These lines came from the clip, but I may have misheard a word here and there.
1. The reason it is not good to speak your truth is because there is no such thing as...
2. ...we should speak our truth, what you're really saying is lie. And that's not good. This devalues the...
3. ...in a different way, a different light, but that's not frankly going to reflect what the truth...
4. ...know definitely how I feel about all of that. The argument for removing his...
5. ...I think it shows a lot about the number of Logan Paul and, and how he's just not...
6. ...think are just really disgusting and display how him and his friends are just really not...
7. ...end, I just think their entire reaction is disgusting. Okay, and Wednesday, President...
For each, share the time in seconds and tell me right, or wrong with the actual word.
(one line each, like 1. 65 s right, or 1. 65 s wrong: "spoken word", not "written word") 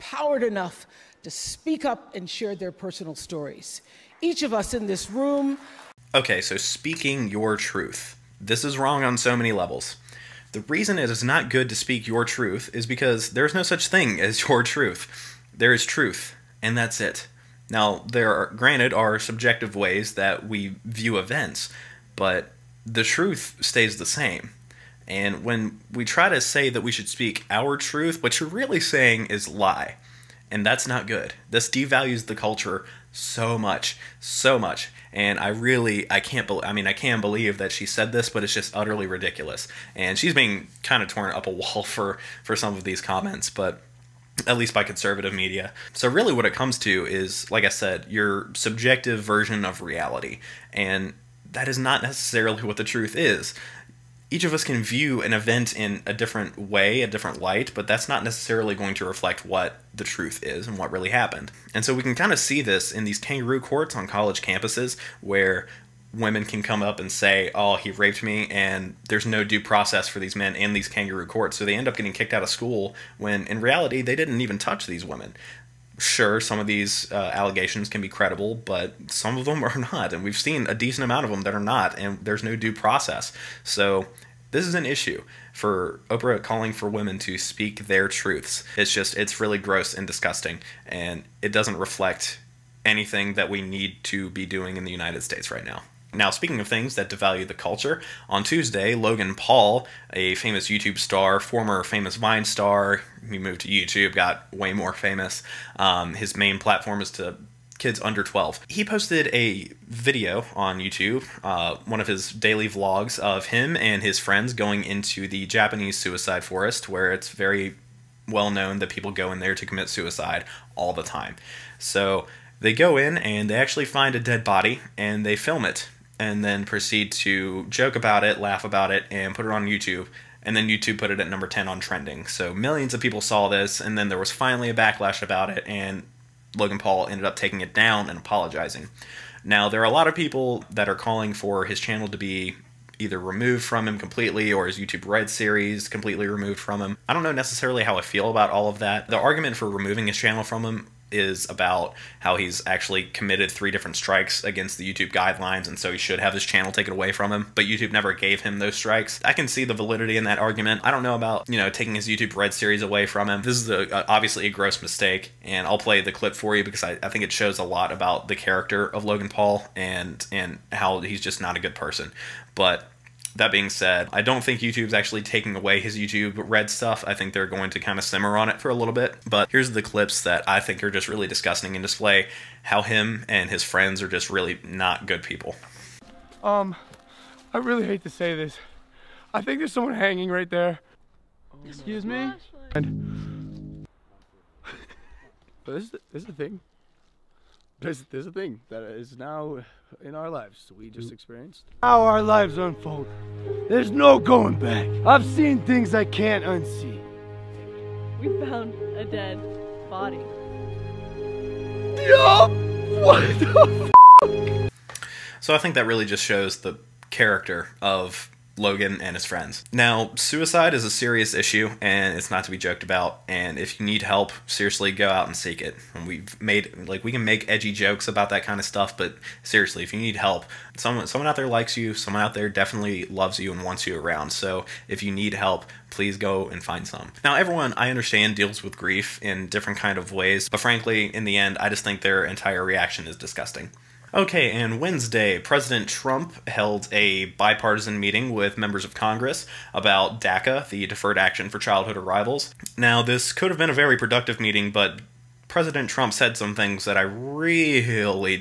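1. 10 s right
2. 26 s right
3. 55 s wrong: "necessarily", not "frankly"
4. 147 s wrong: "necessarily", not "definitely"
5. 167 s wrong: "character", not "number"
6. 180 s right
7. 241 s right.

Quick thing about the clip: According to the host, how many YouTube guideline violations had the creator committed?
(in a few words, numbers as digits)
3.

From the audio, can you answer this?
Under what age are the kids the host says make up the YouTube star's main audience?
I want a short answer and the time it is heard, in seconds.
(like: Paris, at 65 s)
12, at 108 s.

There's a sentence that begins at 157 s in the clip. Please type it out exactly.
But YouTube never gave him those strikes.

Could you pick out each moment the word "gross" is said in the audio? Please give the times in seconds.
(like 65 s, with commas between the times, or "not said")
89 s, 164 s.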